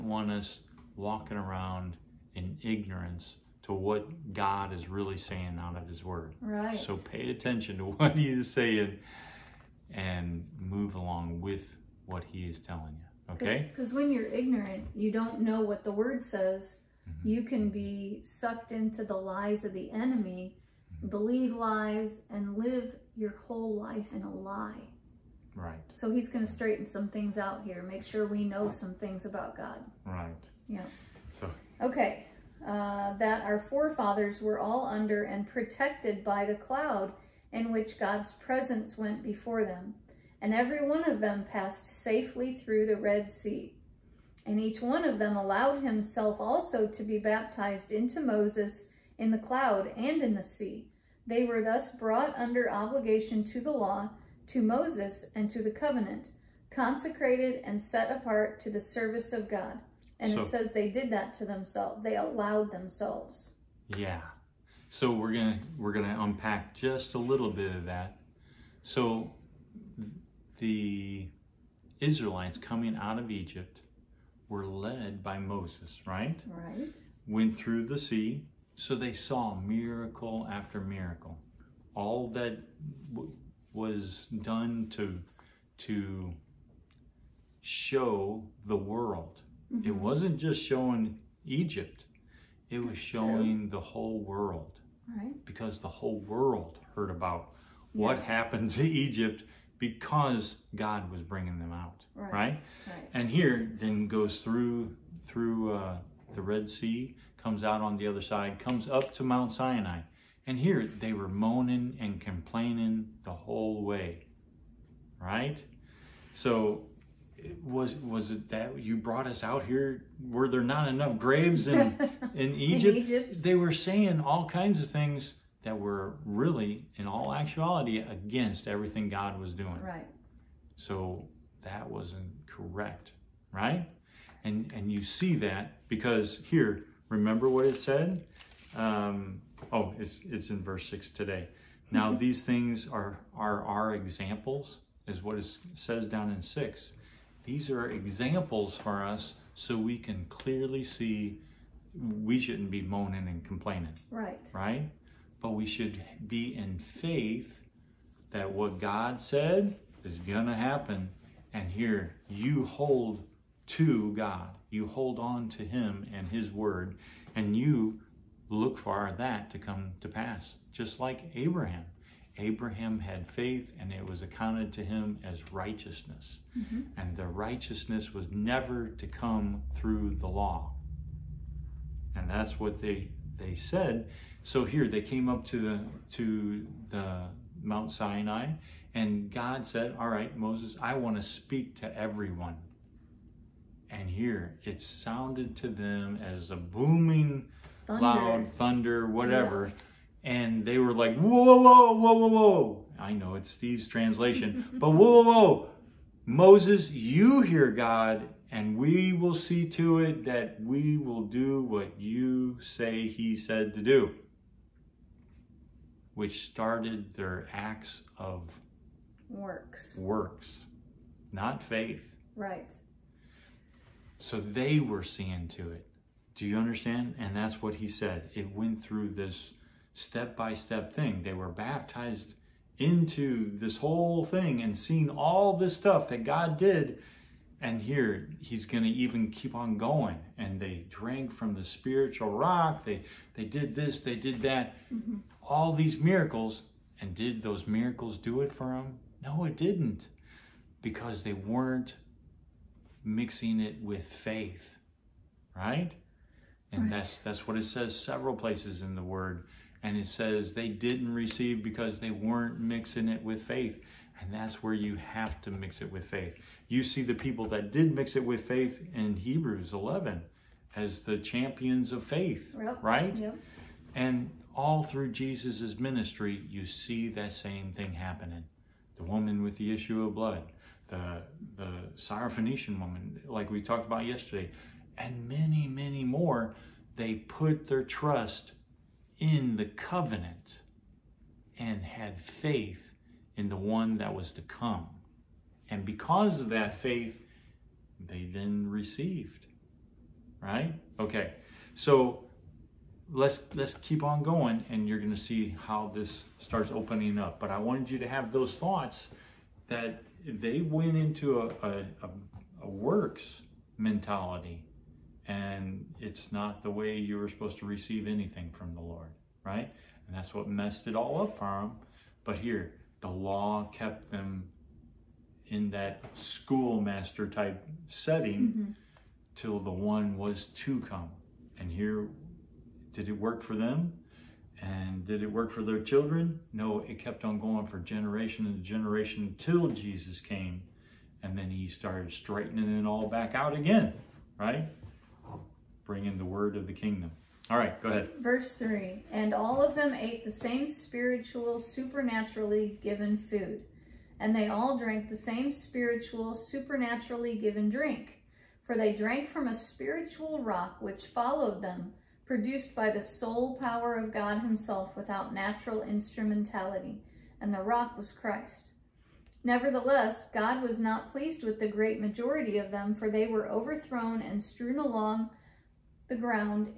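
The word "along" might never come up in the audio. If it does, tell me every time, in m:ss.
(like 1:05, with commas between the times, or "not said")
0:10, 6:14.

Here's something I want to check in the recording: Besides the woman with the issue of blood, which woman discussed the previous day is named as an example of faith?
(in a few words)
Syrophoenician woman.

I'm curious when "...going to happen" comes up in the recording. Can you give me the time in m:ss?
2:40.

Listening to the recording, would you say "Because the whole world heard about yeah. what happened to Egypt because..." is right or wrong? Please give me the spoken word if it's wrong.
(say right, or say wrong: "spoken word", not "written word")
right.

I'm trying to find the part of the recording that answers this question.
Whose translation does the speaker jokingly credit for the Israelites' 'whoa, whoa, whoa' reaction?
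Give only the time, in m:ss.
3:23.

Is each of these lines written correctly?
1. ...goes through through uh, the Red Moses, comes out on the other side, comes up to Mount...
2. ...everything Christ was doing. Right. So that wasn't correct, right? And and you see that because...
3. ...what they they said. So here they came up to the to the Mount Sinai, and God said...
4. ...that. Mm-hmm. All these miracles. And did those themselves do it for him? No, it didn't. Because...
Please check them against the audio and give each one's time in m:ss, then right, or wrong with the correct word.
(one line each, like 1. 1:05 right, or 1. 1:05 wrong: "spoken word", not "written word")
1. 1:44 wrong: "Sea", not "Moses"
2. 2:08 wrong: "God", not "Christ"
3. 3:02 right
4. 4:04 wrong: "miracles", not "themselves".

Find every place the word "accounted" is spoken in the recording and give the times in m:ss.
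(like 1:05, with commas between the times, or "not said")
2:54.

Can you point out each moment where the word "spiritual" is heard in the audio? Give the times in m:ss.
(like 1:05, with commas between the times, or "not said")
4:01, 5:50, 5:55, 5:59.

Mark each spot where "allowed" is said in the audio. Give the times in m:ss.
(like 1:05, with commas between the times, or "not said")
0:45, 1:02.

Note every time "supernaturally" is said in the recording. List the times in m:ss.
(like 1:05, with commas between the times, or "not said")
5:51, 5:56.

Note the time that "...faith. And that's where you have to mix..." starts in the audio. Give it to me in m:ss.
4:23.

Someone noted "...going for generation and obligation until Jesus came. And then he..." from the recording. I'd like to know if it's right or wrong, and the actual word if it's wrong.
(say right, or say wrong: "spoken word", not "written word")
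wrong: "generation", not "obligation".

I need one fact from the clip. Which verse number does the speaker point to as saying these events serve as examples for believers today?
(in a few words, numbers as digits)
6.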